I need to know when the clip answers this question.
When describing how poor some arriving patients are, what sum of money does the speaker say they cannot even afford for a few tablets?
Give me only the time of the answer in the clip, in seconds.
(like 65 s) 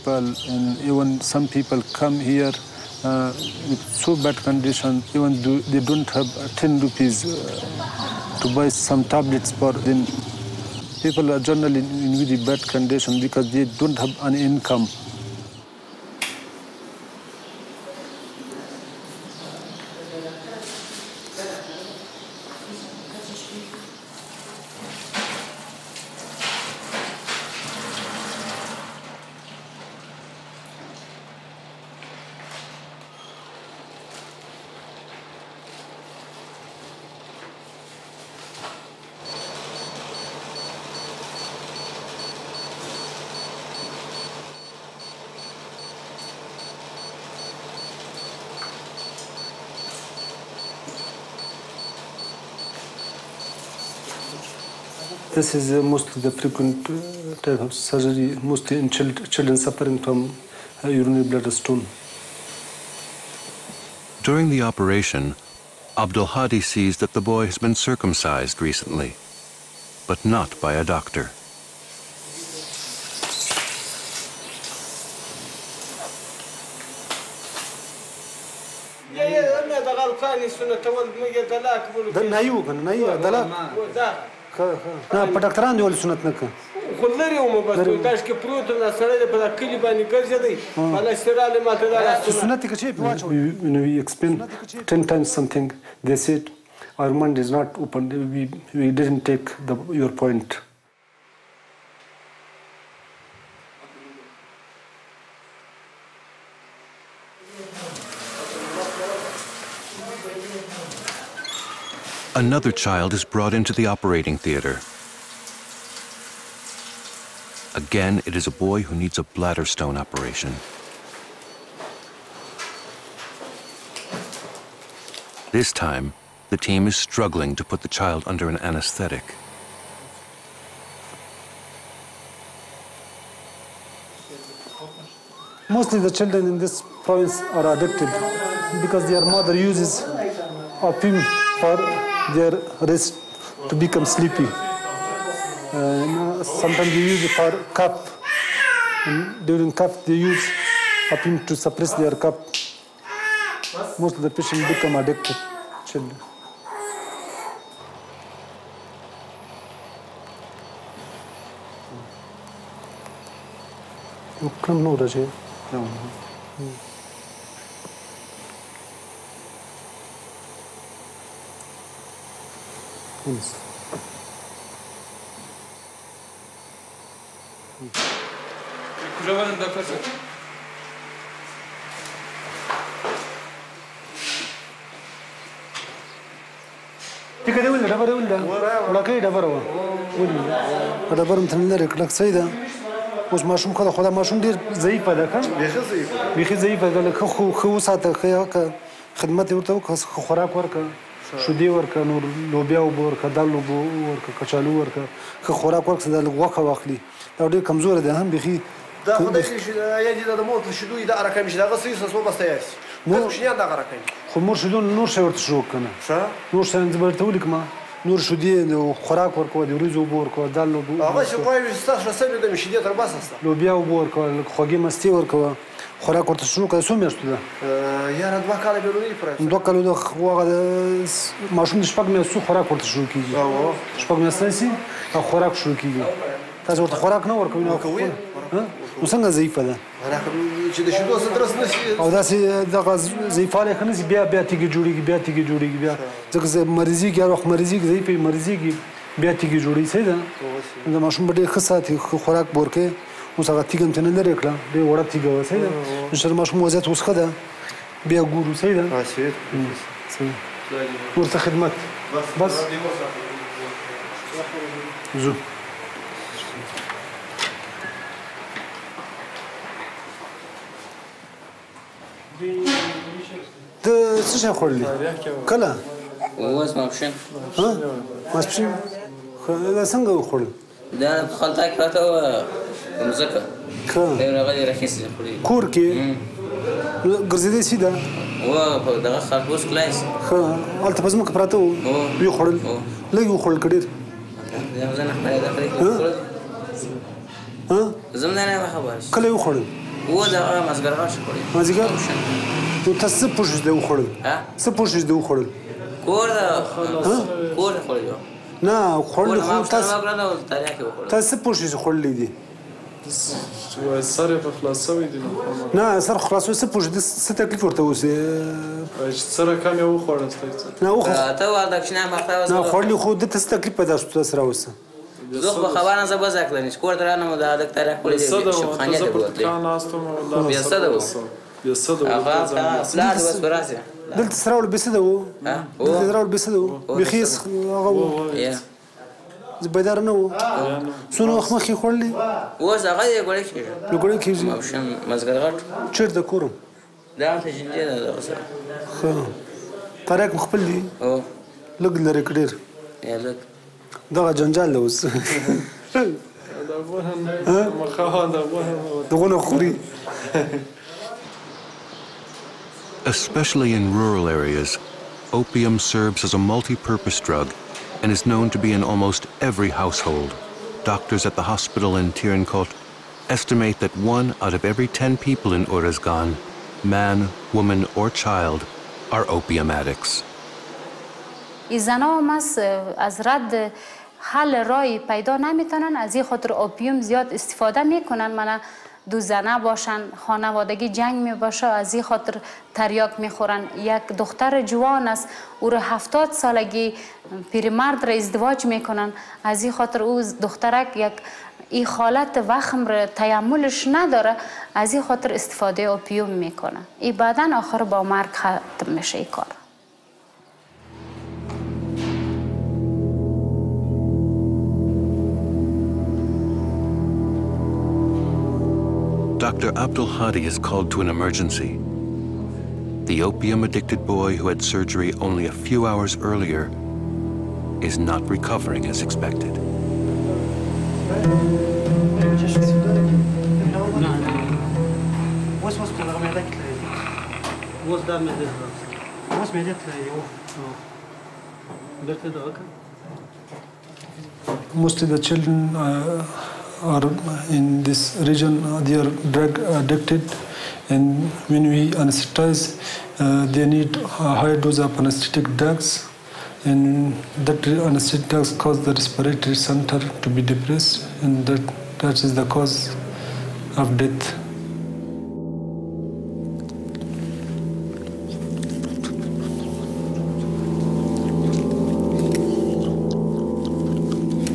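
6 s.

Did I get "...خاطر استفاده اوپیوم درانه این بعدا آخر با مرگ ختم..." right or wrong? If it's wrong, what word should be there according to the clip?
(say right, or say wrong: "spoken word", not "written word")
wrong: "میکنه", not "درانه".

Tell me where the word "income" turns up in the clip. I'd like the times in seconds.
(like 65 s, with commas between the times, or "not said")
14 s.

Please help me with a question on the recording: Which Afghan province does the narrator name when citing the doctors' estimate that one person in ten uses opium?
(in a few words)
Uruzgan.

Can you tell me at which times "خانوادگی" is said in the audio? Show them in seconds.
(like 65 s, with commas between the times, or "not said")
390 s.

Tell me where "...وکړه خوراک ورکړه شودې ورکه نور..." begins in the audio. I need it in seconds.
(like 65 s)
199 s.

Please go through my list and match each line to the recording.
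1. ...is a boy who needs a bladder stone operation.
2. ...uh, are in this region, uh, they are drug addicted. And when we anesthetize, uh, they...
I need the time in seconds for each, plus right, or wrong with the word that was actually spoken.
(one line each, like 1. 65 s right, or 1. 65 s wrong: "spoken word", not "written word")
1. 118 s right
2. 445 s right.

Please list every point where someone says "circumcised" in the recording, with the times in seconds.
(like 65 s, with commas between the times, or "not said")
67 s.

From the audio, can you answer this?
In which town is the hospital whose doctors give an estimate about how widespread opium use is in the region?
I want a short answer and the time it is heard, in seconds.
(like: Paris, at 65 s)
Tarin Kowt, at 372 s.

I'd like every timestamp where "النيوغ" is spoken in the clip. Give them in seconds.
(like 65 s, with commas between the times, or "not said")
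82 s.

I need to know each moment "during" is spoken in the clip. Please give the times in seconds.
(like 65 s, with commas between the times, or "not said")
64 s, 149 s.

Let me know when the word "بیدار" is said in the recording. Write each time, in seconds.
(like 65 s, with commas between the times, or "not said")
339 s.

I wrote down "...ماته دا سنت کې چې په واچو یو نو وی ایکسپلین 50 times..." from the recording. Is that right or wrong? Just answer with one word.
wrong.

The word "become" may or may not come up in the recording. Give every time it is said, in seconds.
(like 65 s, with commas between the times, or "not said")
143 s, 154 s.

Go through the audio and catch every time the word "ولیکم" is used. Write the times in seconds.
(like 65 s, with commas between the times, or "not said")
217 s.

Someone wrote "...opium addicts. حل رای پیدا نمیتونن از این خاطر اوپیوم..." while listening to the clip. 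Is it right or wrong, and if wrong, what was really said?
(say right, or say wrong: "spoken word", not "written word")
right.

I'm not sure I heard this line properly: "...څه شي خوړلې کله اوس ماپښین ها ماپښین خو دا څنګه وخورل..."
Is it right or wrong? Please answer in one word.
wrong.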